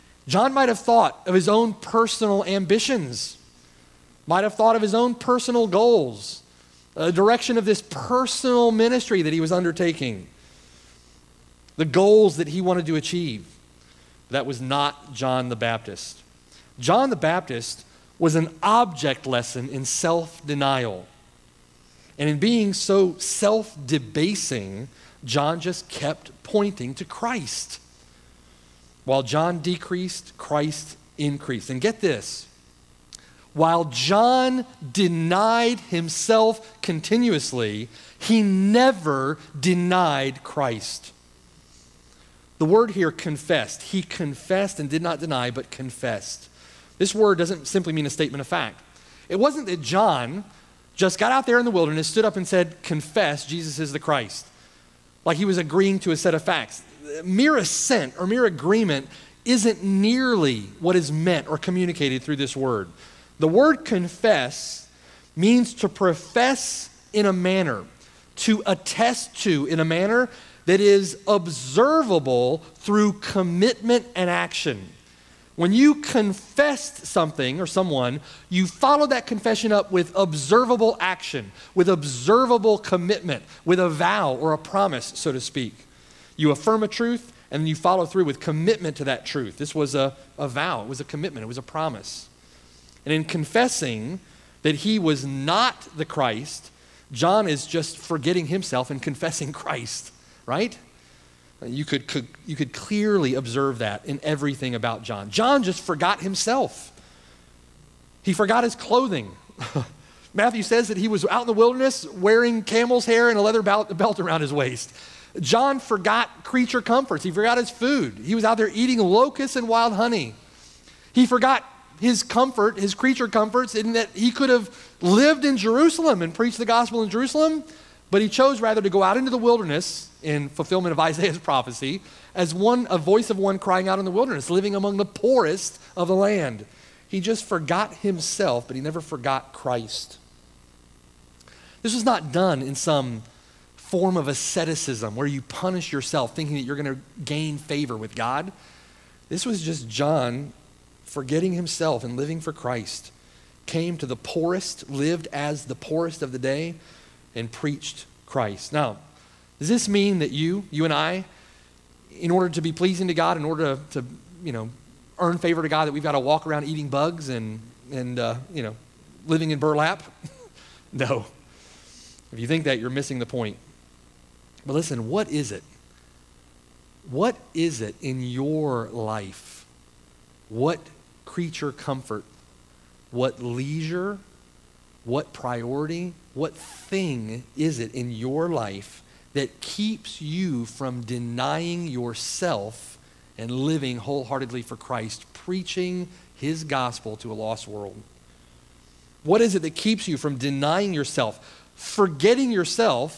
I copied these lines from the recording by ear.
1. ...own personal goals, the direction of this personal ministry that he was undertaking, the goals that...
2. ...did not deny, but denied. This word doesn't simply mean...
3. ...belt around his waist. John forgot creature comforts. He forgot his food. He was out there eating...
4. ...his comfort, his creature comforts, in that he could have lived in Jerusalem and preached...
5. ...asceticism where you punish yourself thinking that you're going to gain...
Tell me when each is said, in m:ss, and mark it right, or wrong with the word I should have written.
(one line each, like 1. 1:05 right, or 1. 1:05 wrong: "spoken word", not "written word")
1. 0:04 right
2. 0:44 wrong: "confessed", not "denied"
3. 1:53 right
4. 2:02 right
5. 2:24 right.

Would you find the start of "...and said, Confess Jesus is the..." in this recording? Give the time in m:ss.
0:52.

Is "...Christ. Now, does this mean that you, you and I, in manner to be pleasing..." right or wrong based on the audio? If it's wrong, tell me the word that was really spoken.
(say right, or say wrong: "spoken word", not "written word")
wrong: "order", not "manner".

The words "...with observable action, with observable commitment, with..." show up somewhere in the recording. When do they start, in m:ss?
1:19.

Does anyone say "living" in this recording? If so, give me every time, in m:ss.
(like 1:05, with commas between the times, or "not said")
2:14, 2:32, 2:49, 3:13.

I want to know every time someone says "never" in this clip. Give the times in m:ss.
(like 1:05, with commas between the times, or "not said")
0:38, 2:18.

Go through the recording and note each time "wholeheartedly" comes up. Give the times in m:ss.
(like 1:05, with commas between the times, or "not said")
3:13.